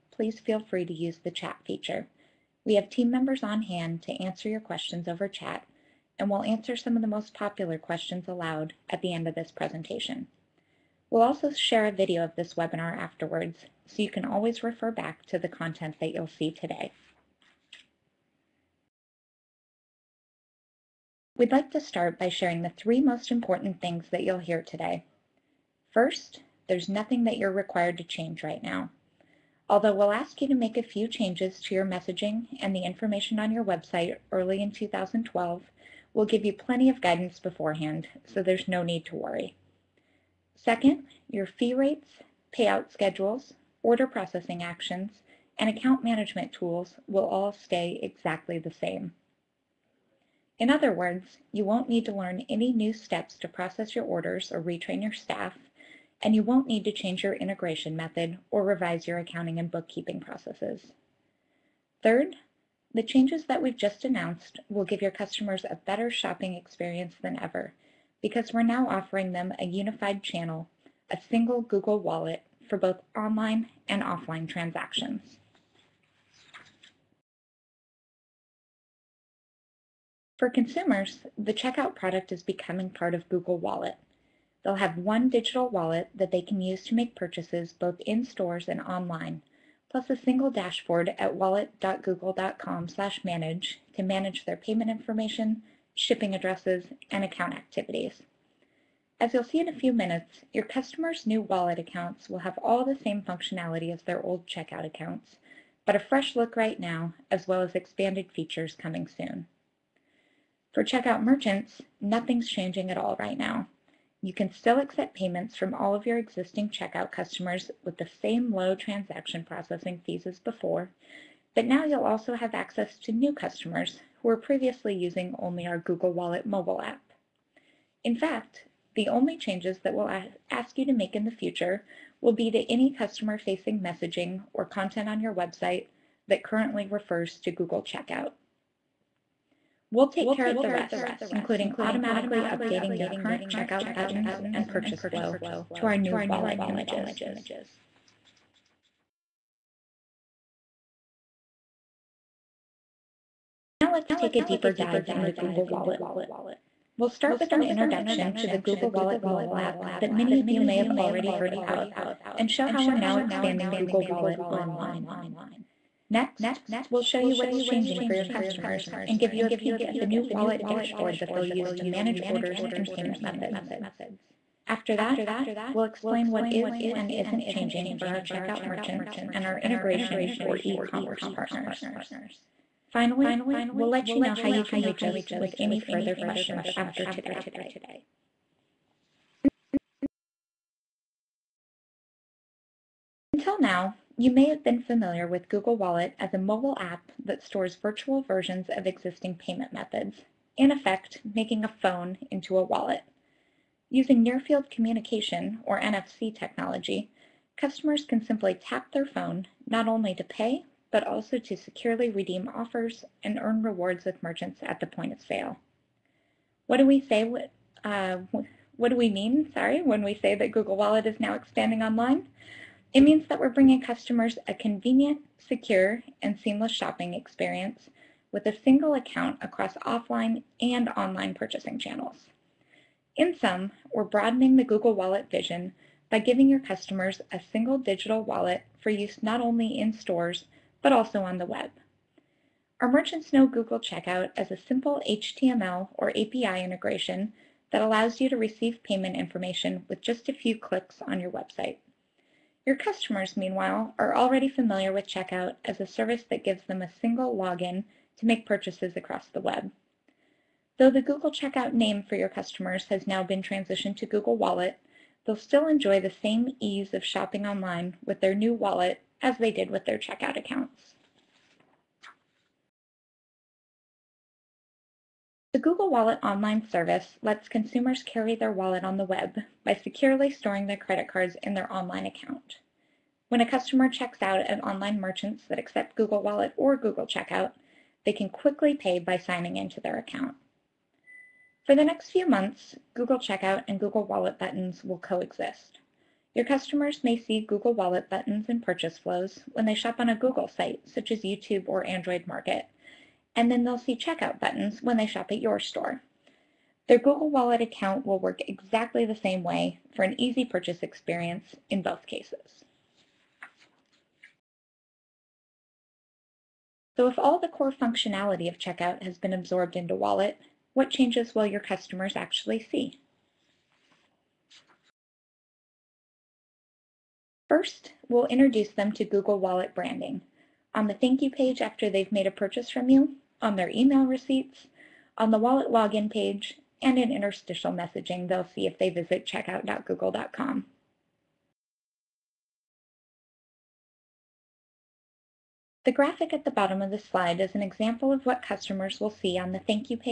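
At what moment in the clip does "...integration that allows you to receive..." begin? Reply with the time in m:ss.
4:06.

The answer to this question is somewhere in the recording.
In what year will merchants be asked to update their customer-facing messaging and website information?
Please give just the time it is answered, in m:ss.
0:34.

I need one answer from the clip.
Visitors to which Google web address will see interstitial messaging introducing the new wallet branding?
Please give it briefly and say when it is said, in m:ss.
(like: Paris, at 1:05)
checkout.google.com, at 5:39.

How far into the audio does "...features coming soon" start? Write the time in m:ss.
1:48.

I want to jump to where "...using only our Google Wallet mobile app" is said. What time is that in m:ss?
2:04.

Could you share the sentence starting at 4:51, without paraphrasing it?
For the next few months, Google Checkout and Google Wallet buttons will coexist.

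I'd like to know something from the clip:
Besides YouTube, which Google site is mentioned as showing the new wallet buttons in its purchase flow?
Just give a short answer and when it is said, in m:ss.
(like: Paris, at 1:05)
Android Market, at 5:01.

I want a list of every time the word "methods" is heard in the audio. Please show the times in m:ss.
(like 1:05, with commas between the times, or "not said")
0:57, 2:53, 3:19.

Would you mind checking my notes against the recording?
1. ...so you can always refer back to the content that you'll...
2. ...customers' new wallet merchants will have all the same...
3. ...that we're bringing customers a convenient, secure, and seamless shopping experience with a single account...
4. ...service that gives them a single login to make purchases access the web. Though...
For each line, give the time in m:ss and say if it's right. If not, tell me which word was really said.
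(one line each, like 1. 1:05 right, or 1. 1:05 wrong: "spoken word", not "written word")
1. 0:13 right
2. 1:40 wrong: "accounts", not "merchants"
3. 3:43 right
4. 4:15 wrong: "across", not "access".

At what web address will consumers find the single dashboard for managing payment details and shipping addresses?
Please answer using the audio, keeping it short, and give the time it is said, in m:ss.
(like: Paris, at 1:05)
wallet.google.com, at 1:31.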